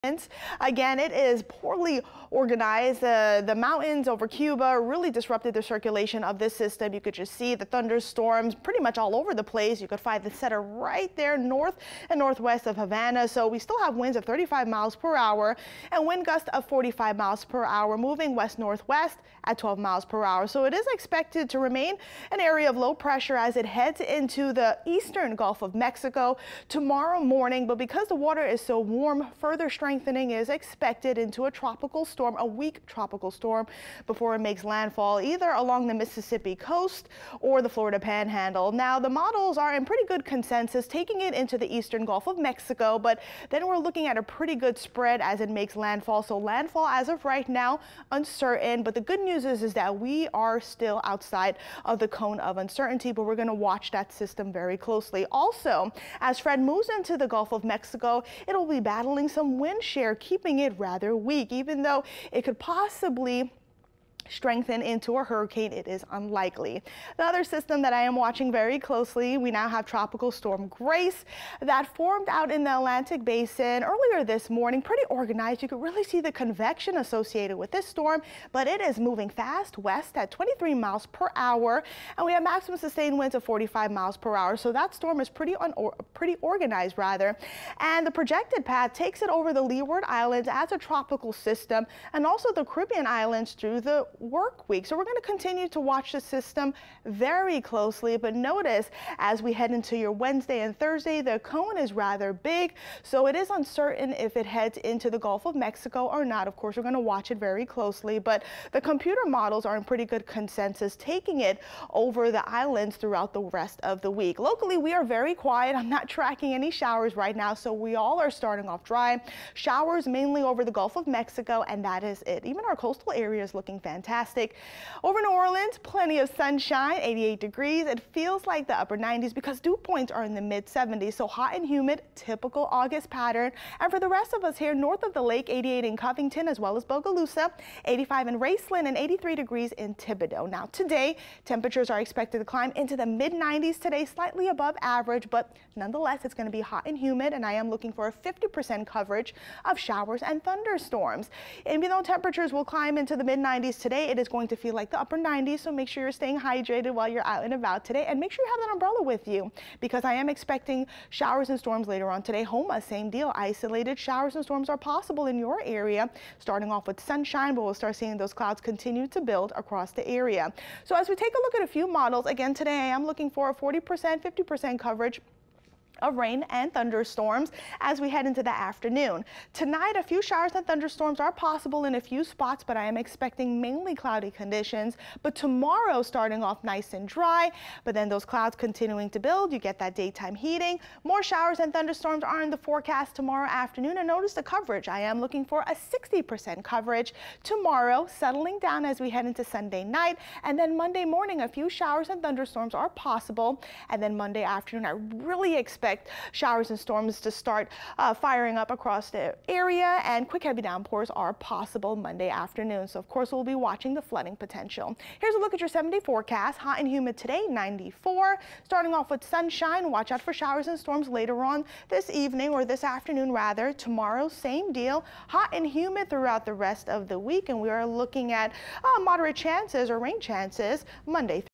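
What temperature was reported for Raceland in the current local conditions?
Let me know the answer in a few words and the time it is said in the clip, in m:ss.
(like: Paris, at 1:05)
85, at 2:17.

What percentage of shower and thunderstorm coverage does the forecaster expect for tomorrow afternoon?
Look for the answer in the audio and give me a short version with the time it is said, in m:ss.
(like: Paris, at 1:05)
60%, at 3:15.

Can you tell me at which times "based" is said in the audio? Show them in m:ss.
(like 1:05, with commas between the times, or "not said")
not said.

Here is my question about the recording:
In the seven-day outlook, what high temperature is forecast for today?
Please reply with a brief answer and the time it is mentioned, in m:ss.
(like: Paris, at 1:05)
94, at 3:37.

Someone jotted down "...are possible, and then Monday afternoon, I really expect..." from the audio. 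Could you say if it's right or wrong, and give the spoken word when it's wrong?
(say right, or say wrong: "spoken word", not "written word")
right.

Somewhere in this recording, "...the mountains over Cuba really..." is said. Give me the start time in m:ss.
0:03.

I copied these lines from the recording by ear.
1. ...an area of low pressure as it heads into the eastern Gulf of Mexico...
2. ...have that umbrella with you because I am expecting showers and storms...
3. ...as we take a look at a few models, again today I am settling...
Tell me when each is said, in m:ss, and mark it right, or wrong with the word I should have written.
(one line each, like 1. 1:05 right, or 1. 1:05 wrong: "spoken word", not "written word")
1. 0:22 right
2. 2:38 right
3. 2:50 wrong: "looking", not "settling".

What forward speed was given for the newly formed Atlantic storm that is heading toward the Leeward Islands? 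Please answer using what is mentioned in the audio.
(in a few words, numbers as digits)
23 miles per hour.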